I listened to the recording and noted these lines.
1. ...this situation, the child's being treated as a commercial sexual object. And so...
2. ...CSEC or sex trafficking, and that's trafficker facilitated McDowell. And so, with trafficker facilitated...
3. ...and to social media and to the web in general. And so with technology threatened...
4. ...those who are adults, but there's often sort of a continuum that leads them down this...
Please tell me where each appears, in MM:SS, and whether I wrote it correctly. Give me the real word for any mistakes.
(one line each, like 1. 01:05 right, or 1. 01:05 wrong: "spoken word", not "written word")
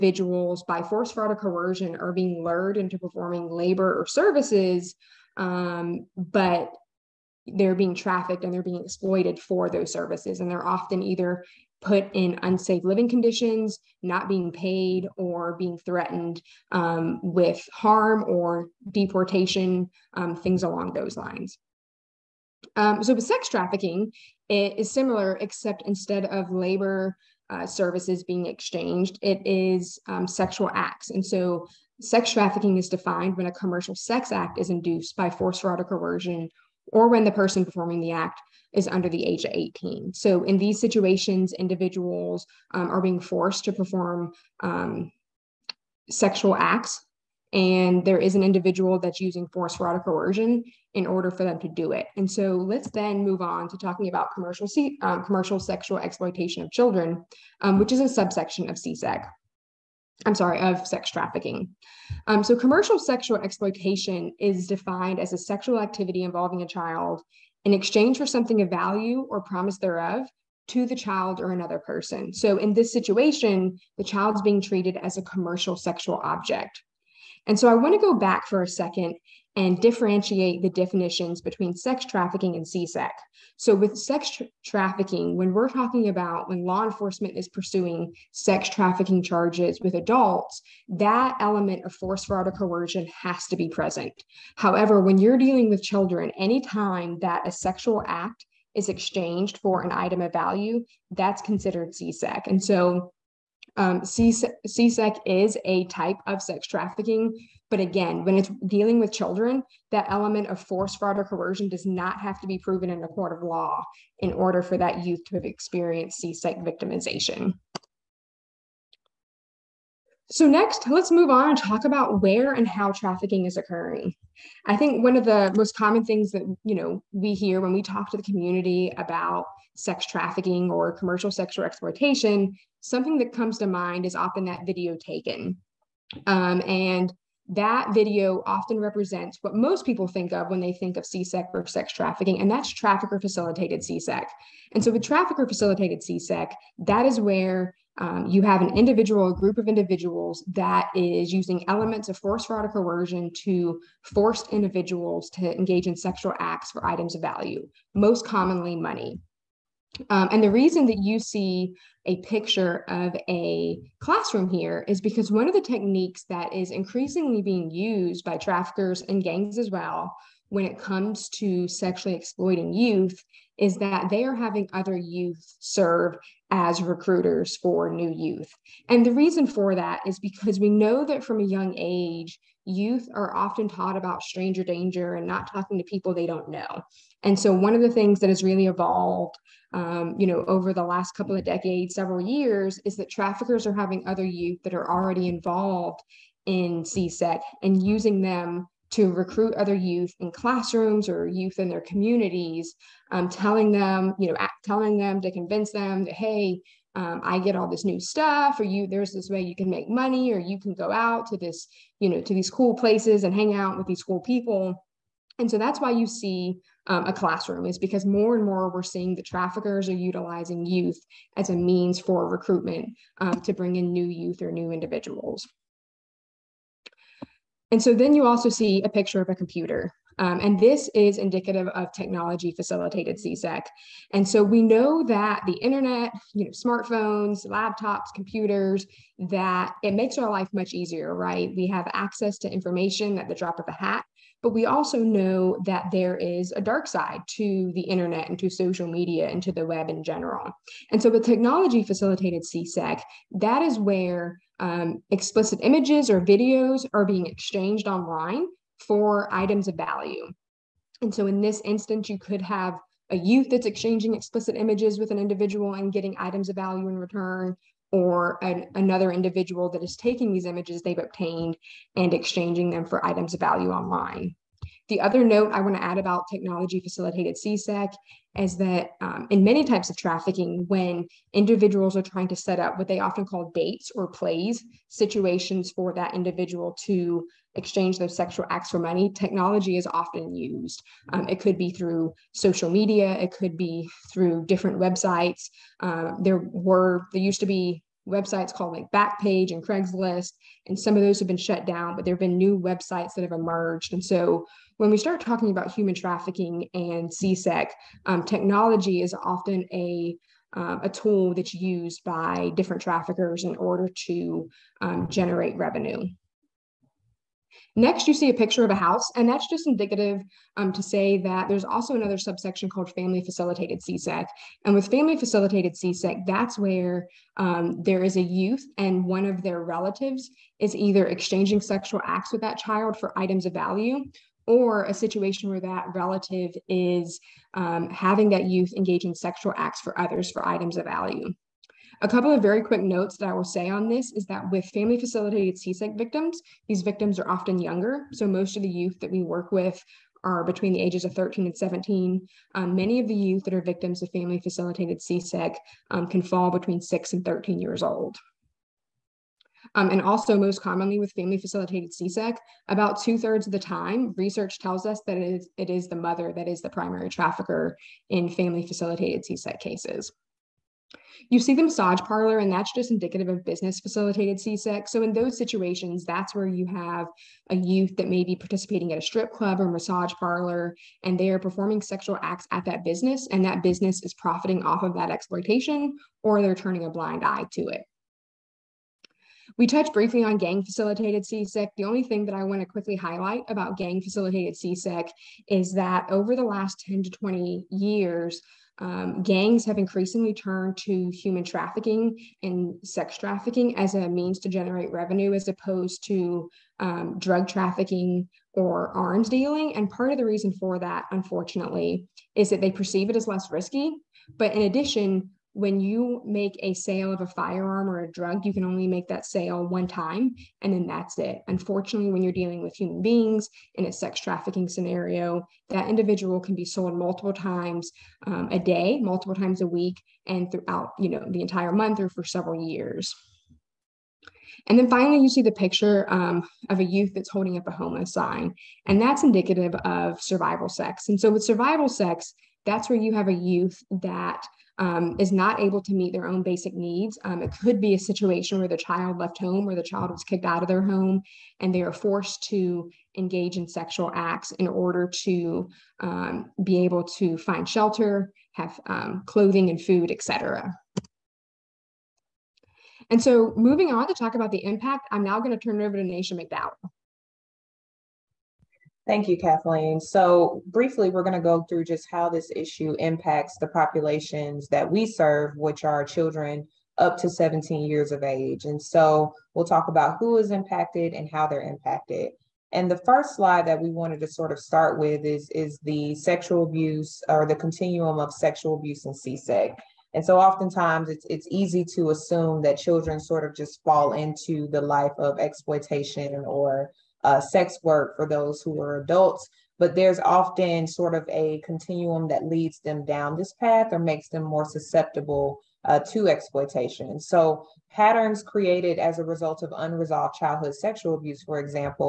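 1. 01:12 right
2. 02:21 wrong: "CSEC", not "McDowell"
3. 04:08 wrong: "facilitated", not "threatened"
4. 08:18 right.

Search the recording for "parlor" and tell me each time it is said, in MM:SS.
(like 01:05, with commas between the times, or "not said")
06:11, 06:20.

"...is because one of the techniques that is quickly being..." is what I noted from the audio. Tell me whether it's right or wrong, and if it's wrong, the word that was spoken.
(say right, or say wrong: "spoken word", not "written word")
wrong: "increasingly", not "quickly".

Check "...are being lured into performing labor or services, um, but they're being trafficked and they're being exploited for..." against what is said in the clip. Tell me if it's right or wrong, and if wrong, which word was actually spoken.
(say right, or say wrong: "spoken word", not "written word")
right.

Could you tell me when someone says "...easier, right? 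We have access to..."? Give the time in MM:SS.
04:00.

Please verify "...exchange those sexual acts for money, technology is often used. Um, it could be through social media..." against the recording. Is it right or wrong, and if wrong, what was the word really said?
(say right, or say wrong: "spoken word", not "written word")
right.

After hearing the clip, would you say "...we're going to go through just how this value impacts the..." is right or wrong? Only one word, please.
wrong.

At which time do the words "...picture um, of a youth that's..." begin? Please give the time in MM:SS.
07:15.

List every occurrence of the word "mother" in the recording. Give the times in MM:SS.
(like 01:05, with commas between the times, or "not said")
06:05.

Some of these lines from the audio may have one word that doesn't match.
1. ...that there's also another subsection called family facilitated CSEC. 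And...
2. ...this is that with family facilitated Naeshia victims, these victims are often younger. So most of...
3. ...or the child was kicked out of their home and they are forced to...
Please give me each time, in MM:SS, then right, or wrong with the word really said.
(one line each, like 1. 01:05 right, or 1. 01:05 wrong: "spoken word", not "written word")
1. 05:21 right
2. 05:43 wrong: "CSEC", not "Naeshia"
3. 07:29 right.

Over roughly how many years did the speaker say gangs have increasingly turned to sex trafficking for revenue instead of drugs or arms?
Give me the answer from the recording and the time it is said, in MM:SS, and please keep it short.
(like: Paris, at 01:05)
10 to 20 years, at 06:36.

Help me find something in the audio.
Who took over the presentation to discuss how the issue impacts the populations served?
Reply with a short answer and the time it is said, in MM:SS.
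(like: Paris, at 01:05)
Naeshia McDowell, at 07:46.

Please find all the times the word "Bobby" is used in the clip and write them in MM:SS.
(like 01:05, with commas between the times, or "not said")
not said.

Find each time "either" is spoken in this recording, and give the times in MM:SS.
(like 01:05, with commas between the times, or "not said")
00:11, 05:30.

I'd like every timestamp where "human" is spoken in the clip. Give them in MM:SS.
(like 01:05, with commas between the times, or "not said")
05:05, 06:41, 07:02.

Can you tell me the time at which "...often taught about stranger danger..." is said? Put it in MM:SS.
03:03.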